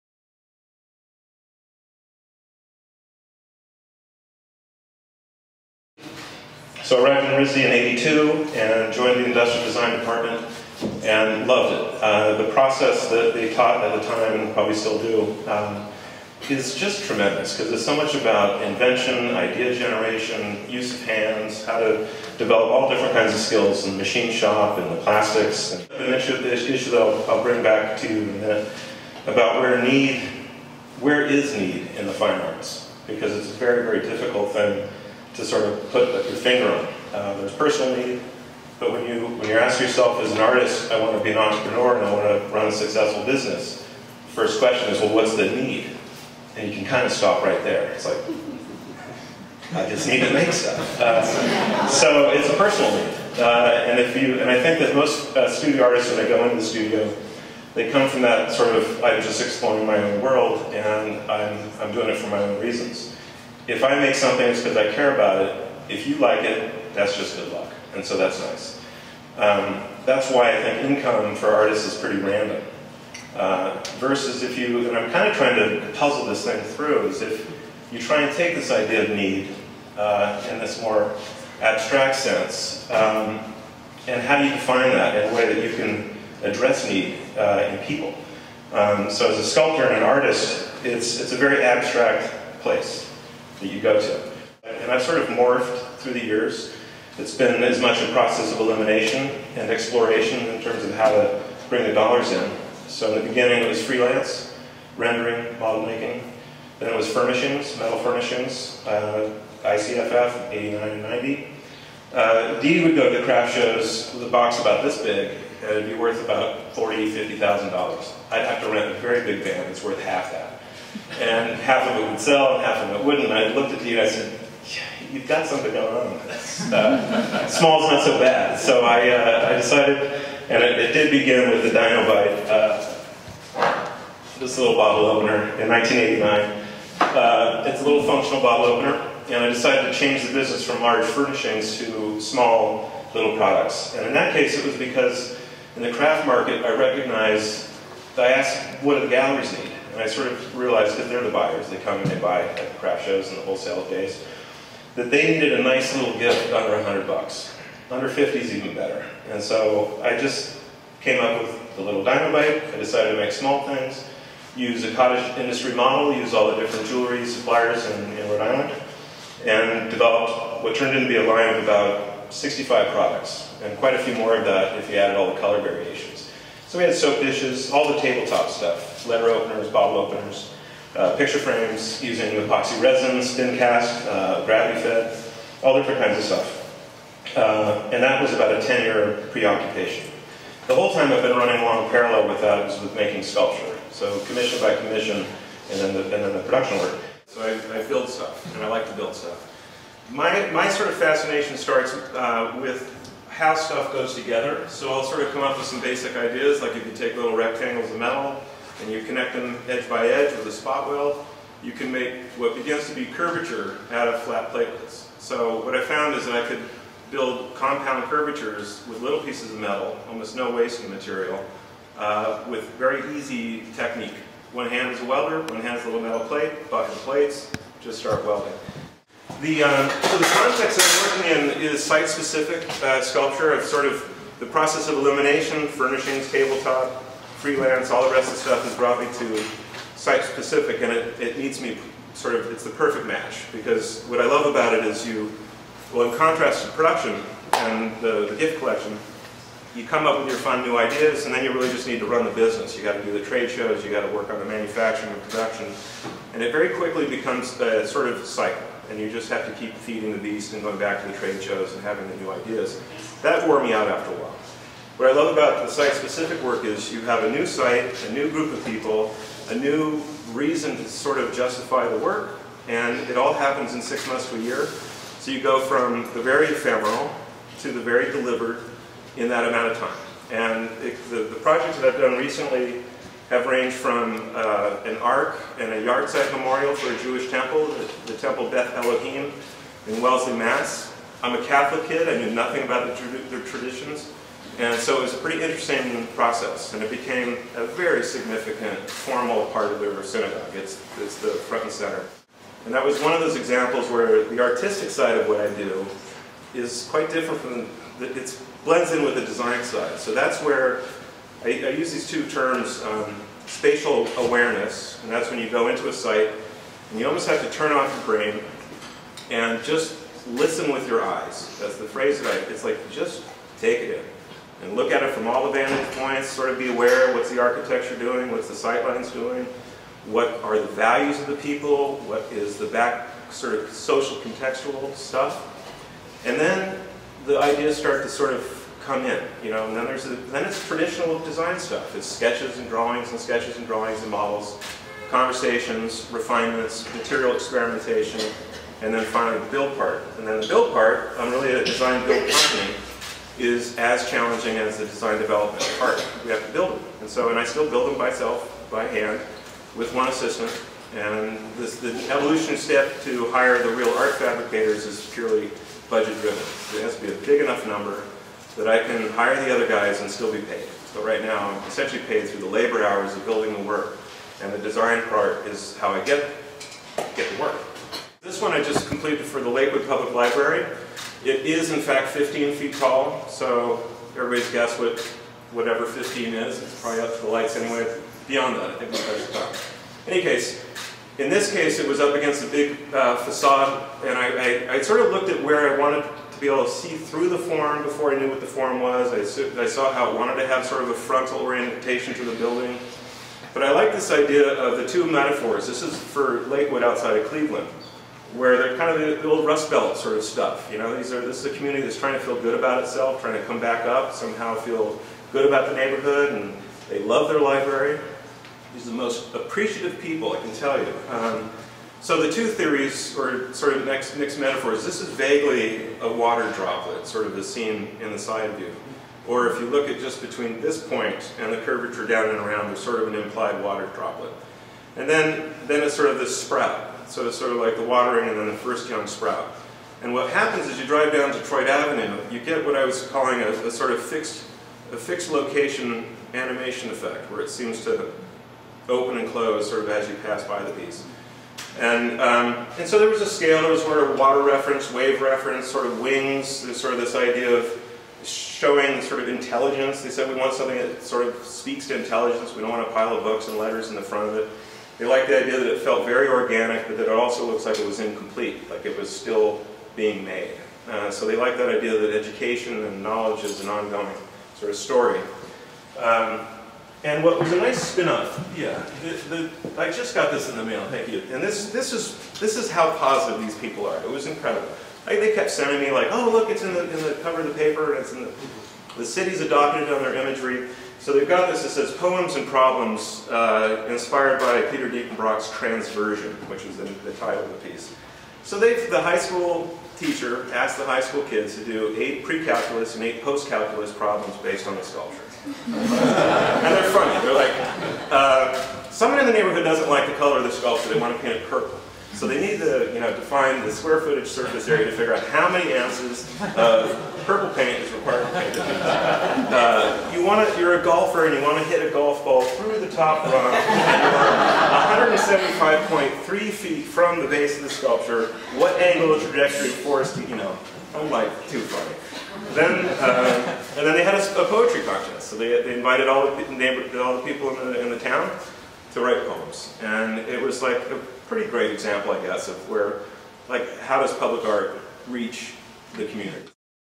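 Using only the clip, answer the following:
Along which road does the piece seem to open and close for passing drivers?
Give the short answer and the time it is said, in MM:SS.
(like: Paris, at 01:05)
Detroit Avenue, at 07:21.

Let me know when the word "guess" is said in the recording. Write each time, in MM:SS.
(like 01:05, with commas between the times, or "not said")
06:24, 09:02.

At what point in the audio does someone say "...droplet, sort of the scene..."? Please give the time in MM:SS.
07:06.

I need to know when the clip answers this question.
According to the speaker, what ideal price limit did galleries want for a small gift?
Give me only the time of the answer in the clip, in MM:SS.
02:37.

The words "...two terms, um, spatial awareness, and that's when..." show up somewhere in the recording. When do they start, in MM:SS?
05:12.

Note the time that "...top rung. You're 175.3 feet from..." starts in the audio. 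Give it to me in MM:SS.
08:42.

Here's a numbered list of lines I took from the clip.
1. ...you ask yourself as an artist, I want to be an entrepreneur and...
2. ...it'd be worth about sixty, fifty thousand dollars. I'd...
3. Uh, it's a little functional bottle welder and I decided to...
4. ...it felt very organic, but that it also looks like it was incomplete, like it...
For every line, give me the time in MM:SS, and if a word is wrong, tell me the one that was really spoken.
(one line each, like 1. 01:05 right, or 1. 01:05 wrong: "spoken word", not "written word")
1. 00:39 right
2. 01:55 wrong: "forty", not "sixty"
3. 02:17 wrong: "opener", not "welder"
4. 07:45 right.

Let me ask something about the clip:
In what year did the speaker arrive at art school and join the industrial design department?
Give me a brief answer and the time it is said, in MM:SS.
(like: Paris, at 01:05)
1982, at 00:07.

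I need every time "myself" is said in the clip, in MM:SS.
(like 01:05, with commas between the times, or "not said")
05:57.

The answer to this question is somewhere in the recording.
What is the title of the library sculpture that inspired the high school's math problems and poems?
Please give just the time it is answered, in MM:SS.
08:15.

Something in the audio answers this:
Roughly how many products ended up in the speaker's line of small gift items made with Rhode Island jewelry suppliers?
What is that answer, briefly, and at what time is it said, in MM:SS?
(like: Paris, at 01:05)
About 65, at 02:51.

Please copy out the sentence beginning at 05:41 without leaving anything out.
It's sketches and drawings and sketches and drawings and models, conversations, refinements, material experimentation, and then finally the build part.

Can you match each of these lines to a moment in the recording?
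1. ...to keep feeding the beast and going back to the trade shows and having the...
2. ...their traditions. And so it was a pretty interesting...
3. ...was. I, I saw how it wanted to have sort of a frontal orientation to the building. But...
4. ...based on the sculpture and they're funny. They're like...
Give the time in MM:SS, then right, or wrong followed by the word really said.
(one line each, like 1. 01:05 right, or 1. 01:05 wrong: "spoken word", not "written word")
1. 04:19 right
2. 04:53 right
3. 06:38 right
4. 08:24 right.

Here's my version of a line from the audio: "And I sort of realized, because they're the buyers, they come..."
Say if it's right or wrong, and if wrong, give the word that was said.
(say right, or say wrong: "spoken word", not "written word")
right.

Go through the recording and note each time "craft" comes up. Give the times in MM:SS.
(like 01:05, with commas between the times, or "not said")
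01:53, 02:25, 02:32.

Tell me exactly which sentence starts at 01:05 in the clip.
If you like it, that's just good luck.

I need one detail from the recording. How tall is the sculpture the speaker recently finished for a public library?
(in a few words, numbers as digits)
15 feet.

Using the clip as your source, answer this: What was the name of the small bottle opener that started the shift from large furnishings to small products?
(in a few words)
Dino.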